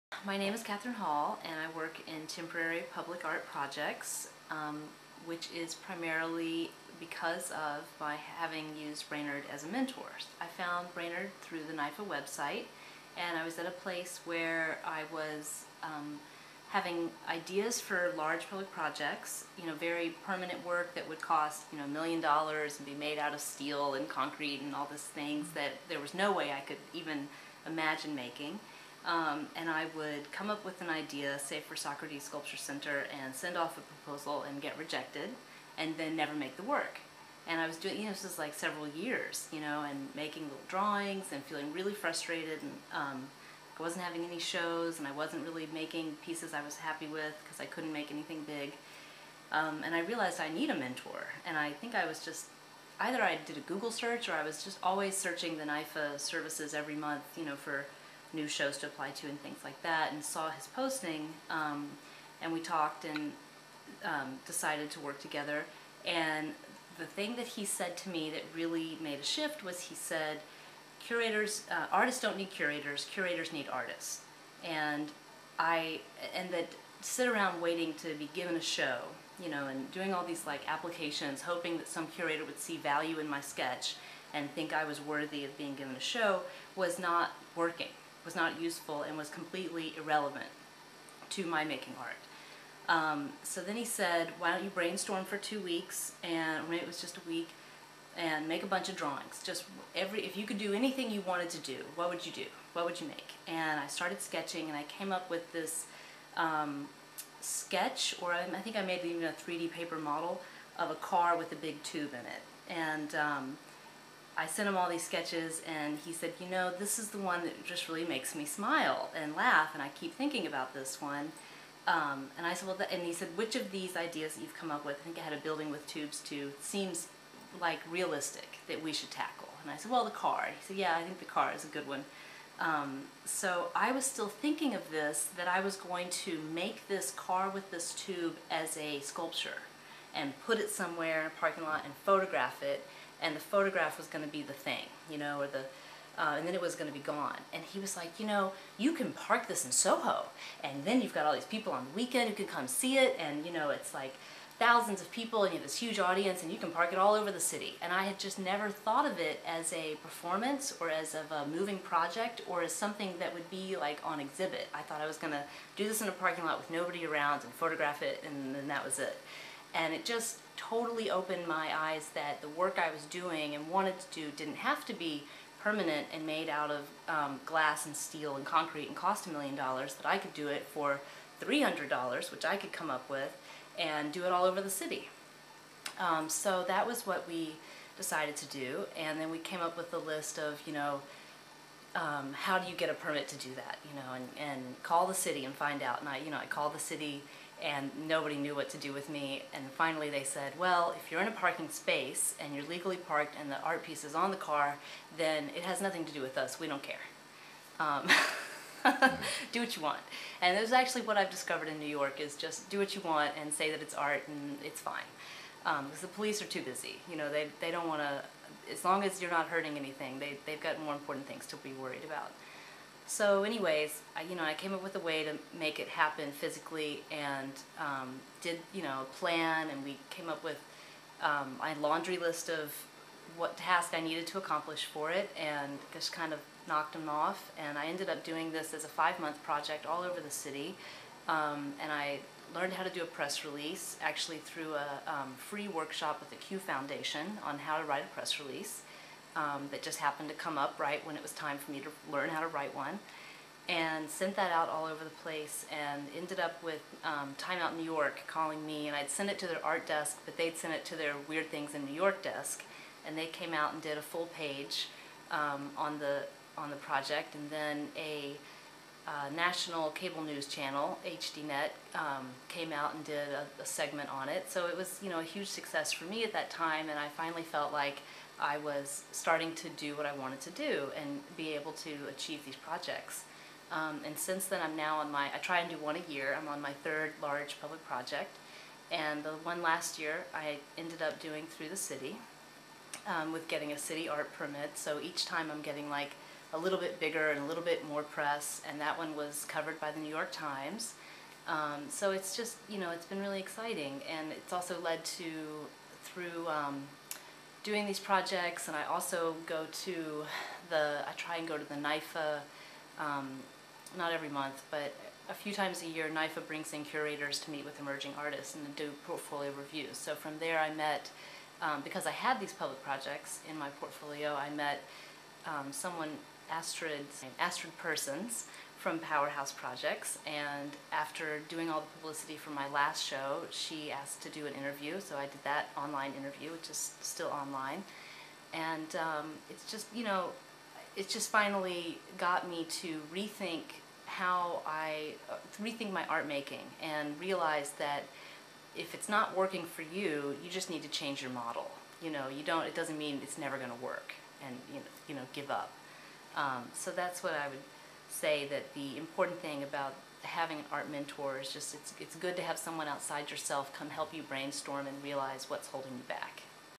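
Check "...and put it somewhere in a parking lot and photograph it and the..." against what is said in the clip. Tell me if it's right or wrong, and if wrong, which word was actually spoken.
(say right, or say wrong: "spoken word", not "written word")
right.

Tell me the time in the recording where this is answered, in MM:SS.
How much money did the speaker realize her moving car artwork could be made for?
03:01.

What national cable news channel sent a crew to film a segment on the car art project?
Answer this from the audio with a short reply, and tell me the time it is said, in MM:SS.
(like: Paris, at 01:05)
HDNet, at 04:31.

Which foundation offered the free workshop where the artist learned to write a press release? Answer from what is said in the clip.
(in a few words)
Q Foundation.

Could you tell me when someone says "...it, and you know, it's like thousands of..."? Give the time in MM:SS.
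02:32.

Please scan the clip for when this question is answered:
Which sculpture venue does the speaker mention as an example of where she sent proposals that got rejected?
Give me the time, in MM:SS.
00:31.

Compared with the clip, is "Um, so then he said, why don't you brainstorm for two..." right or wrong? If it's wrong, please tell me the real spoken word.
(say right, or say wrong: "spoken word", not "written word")
right.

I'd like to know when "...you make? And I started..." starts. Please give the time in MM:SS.
01:42.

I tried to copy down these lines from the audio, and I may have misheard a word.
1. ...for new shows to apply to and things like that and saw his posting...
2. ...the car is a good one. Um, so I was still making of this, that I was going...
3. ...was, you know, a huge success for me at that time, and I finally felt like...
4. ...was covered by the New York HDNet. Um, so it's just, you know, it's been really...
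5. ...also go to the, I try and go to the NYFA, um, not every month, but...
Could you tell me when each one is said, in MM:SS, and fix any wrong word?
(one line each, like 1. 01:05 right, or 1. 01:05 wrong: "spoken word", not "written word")
1. 00:57 right
2. 02:11 wrong: "thinking", not "making"
3. 04:34 right
4. 04:59 wrong: "Times", not "HDNet"
5. 05:08 right.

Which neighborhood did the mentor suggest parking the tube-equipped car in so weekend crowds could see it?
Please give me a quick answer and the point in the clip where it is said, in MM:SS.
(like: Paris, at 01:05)
Soho, at 02:29.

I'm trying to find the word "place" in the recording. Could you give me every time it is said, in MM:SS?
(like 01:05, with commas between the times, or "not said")
00:13, 04:15.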